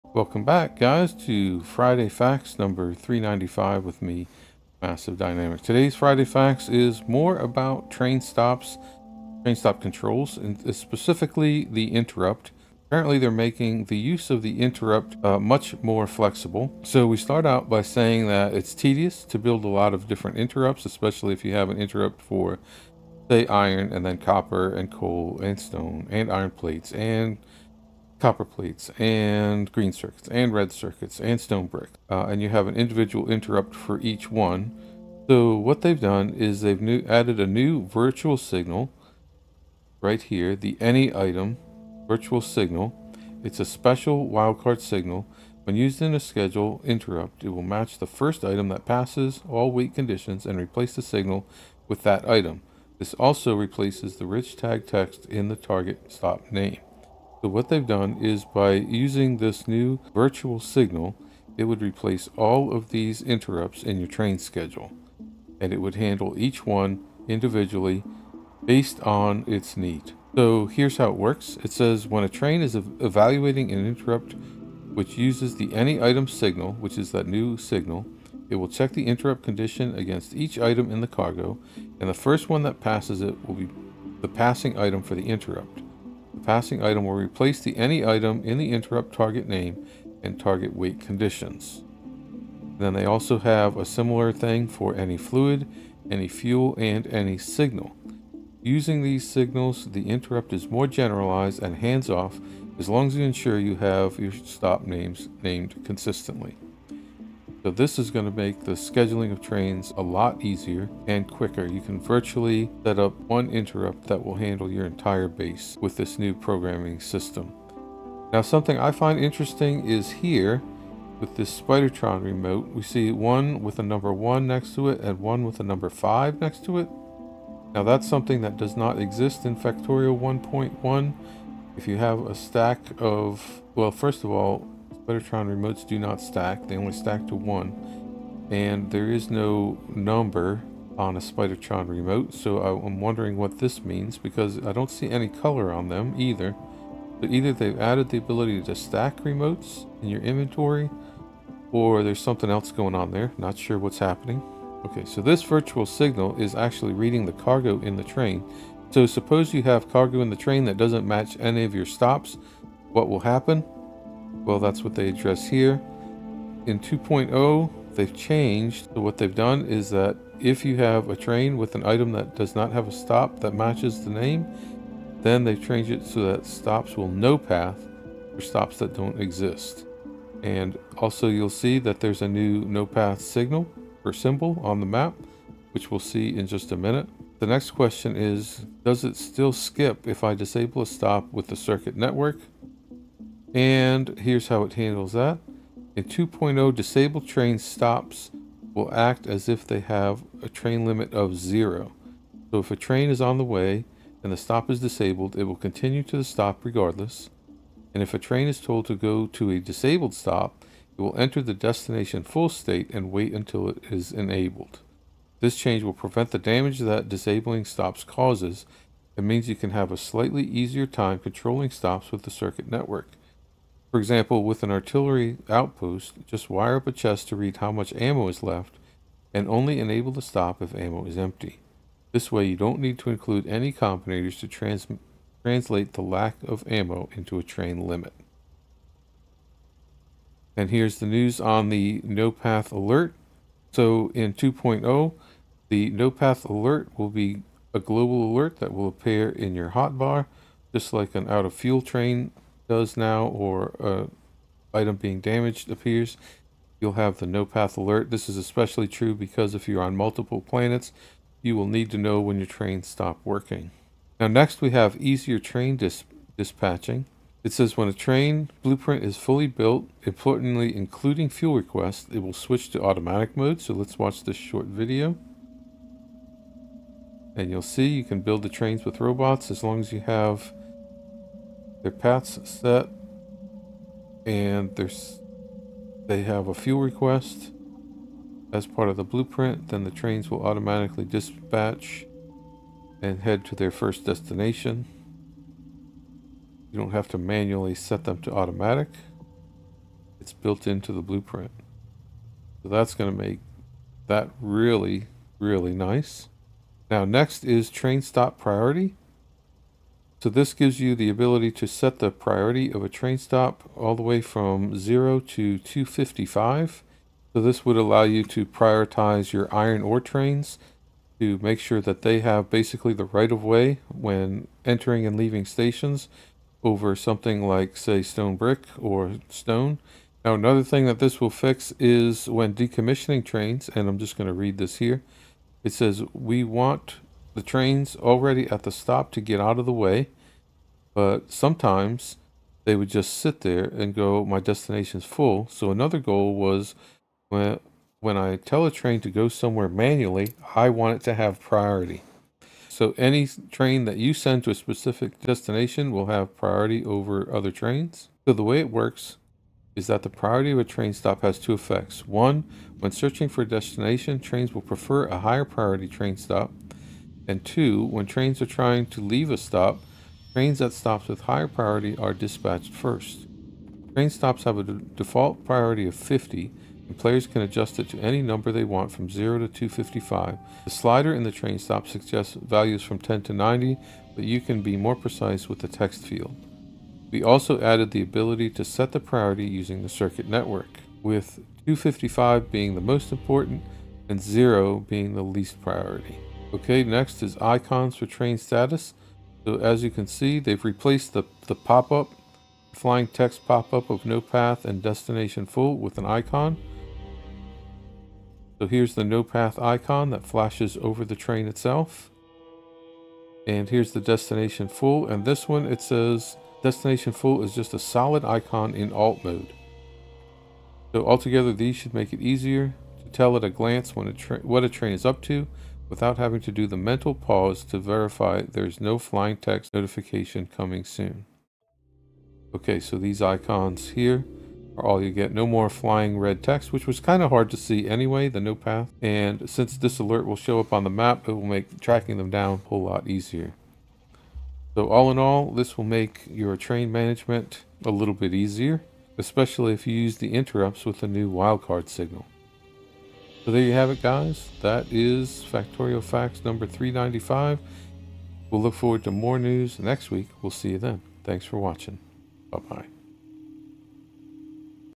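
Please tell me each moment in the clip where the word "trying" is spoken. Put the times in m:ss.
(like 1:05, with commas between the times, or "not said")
6:08.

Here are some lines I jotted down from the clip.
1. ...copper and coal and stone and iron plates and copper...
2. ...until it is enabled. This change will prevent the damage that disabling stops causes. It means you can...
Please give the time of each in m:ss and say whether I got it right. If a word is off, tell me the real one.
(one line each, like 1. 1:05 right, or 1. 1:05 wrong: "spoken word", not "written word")
1. 0:24 right
2. 3:33 right.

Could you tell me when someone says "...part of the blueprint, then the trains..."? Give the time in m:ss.
4:48.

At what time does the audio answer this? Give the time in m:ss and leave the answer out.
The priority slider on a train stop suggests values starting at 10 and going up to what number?
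6:22.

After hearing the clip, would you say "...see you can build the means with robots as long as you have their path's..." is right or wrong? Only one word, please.
wrong.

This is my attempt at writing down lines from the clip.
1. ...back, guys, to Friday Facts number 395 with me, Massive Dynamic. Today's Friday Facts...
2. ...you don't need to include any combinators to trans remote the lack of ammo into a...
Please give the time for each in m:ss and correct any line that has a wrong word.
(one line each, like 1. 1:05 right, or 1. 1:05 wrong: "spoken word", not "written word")
1. 0:00 right
2. 3:52 wrong: "translate", not "remote".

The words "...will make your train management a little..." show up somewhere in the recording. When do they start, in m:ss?
7:25.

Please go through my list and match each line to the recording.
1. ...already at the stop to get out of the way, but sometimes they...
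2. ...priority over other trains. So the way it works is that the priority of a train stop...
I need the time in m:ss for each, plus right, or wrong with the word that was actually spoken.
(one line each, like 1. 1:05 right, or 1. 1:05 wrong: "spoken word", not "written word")
1. 5:37 right
2. 5:56 right.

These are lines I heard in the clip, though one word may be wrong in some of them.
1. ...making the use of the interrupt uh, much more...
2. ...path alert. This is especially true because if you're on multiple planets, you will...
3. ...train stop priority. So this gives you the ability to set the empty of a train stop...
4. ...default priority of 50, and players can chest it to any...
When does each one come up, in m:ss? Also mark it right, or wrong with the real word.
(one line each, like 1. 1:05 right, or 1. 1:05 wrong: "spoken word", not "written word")
1. 0:13 right
2. 4:17 right
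3. 5:07 wrong: "priority", not "empty"
4. 6:14 wrong: "adjust", not "chest".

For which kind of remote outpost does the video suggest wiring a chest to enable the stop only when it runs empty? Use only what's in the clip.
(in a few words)
Artillery outpost.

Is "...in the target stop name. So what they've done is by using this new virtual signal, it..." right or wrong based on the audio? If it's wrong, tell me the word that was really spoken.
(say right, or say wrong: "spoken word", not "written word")
right.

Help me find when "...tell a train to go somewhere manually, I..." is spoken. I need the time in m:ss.
5:48.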